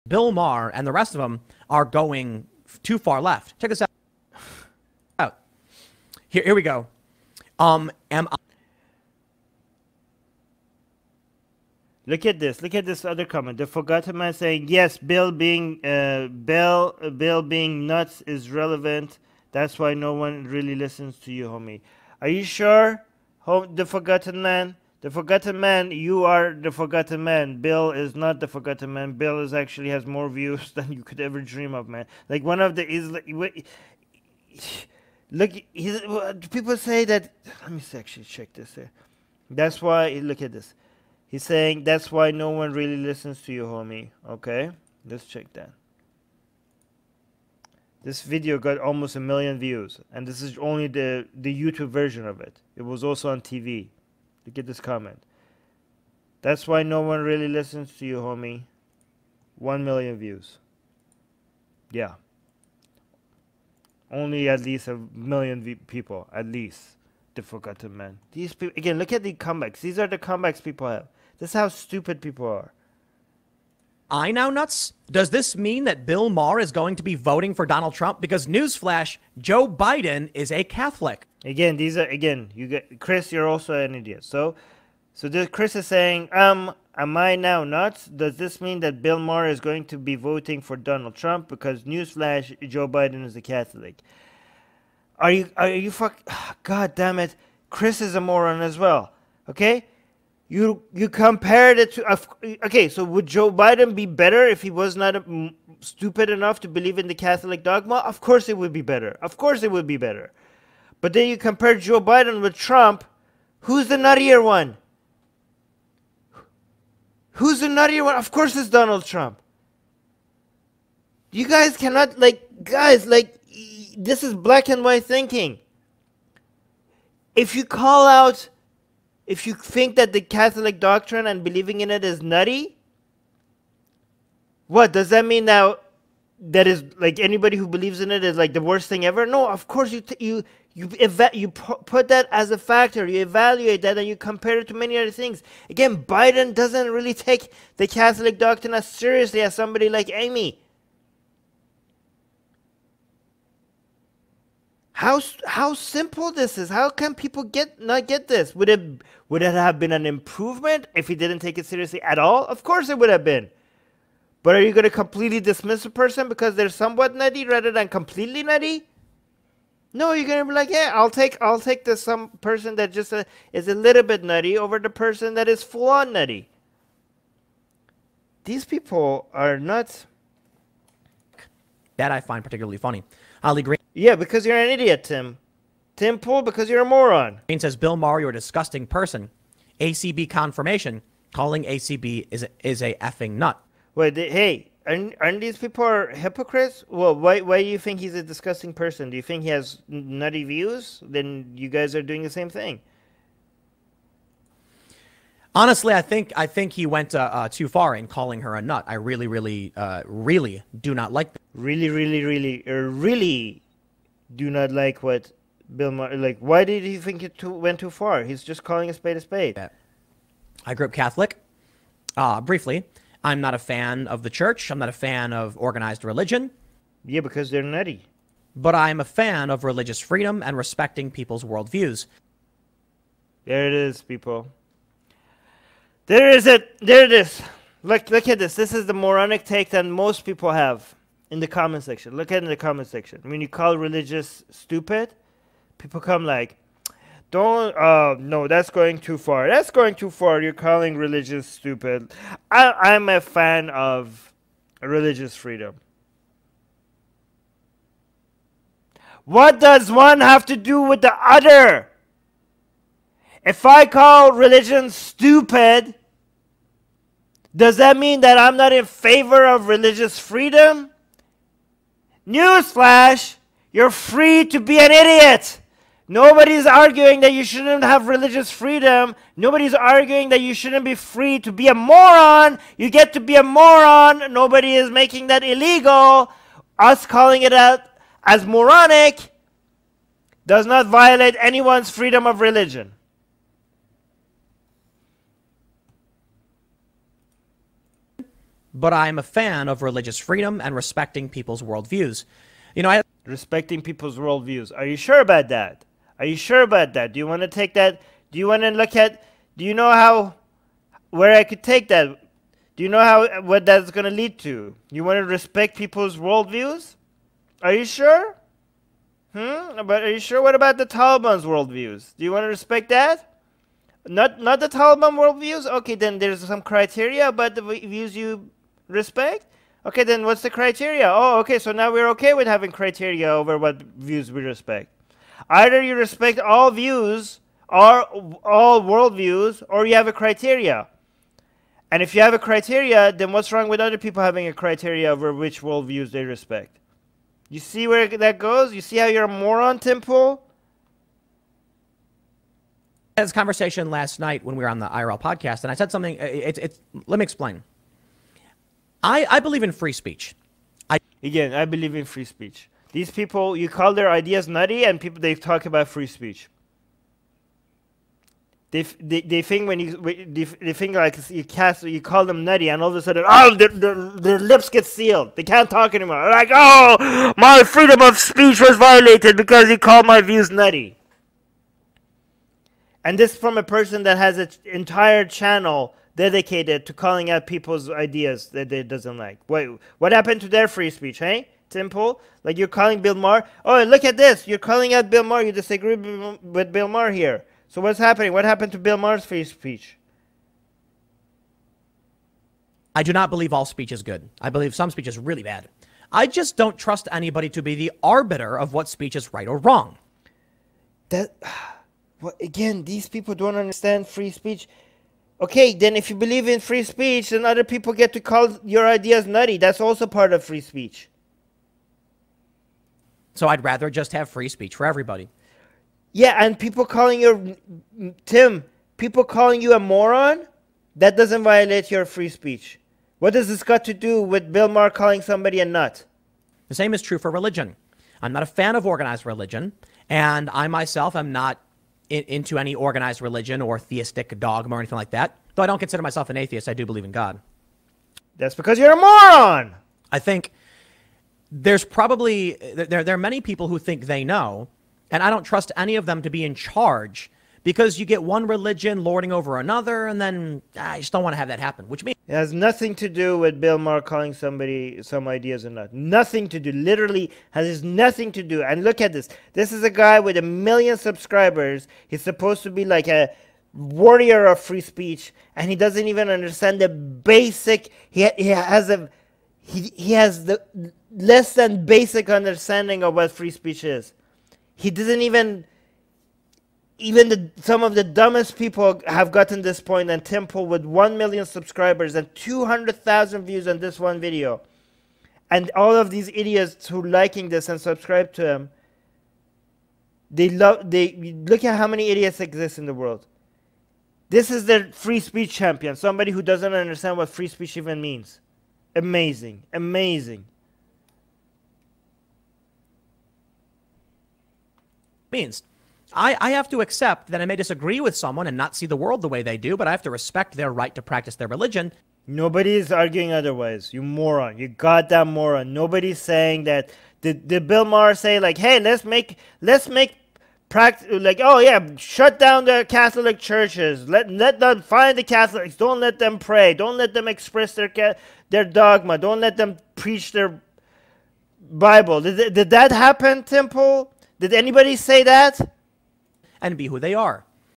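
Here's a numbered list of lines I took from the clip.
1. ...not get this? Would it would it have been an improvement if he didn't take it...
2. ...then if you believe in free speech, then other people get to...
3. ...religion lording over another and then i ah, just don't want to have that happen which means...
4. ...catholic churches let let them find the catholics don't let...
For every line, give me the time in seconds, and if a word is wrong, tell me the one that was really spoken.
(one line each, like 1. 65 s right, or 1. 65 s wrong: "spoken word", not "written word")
1. 157 s right
2. 415 s right
3. 458 s right
4. 532 s right.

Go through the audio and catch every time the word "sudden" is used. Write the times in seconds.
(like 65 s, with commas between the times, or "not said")
373 s.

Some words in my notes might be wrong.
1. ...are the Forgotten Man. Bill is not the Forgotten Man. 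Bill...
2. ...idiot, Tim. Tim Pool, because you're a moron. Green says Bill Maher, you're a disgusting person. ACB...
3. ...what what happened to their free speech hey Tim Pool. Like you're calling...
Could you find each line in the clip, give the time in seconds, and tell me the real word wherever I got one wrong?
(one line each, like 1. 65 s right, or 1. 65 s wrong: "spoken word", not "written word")
1. 26 s right
2. 184 s right
3. 389 s right.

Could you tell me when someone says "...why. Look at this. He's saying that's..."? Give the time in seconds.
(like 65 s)
39 s.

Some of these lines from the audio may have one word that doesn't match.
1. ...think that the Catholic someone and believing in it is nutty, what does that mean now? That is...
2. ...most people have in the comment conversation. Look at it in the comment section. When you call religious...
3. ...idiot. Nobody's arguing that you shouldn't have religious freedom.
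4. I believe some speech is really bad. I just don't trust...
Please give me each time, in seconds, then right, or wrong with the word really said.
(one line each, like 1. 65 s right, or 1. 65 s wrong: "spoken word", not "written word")
1. 129 s wrong: "doctrine", not "someone"
2. 239 s wrong: "section", not "conversation"
3. 274 s right
4. 404 s right.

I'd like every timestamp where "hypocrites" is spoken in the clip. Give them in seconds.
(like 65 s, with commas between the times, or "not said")
196 s.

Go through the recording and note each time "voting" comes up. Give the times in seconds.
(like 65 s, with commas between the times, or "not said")
77 s, 90 s.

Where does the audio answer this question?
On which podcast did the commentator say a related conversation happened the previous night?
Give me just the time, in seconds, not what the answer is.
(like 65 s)
354 s.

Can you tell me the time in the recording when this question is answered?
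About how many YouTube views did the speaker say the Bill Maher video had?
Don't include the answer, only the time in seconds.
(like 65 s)
48 s.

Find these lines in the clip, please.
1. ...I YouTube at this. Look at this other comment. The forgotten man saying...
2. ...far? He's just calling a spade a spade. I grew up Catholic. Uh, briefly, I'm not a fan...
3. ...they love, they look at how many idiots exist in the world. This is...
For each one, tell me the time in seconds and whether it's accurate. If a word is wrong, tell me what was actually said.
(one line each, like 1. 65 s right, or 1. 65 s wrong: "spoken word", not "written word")
1. 8 s wrong: "Look", not "YouTube"
2. 217 s right
3. 500 s right.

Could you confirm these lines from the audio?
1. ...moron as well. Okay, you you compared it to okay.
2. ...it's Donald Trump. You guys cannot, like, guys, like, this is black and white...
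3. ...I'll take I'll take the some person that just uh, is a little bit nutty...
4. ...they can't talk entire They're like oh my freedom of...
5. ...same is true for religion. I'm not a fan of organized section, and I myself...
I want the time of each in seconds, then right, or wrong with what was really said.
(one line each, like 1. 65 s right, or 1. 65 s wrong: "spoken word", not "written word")
1. 98 s right
2. 118 s right
3. 170 s right
4. 375 s wrong: "anymore", not "entire"
5. 436 s wrong: "religion", not "section".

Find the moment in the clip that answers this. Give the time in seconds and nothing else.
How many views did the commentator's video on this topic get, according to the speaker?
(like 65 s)
492 s.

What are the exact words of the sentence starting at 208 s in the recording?
I really, really, uh, really do not like.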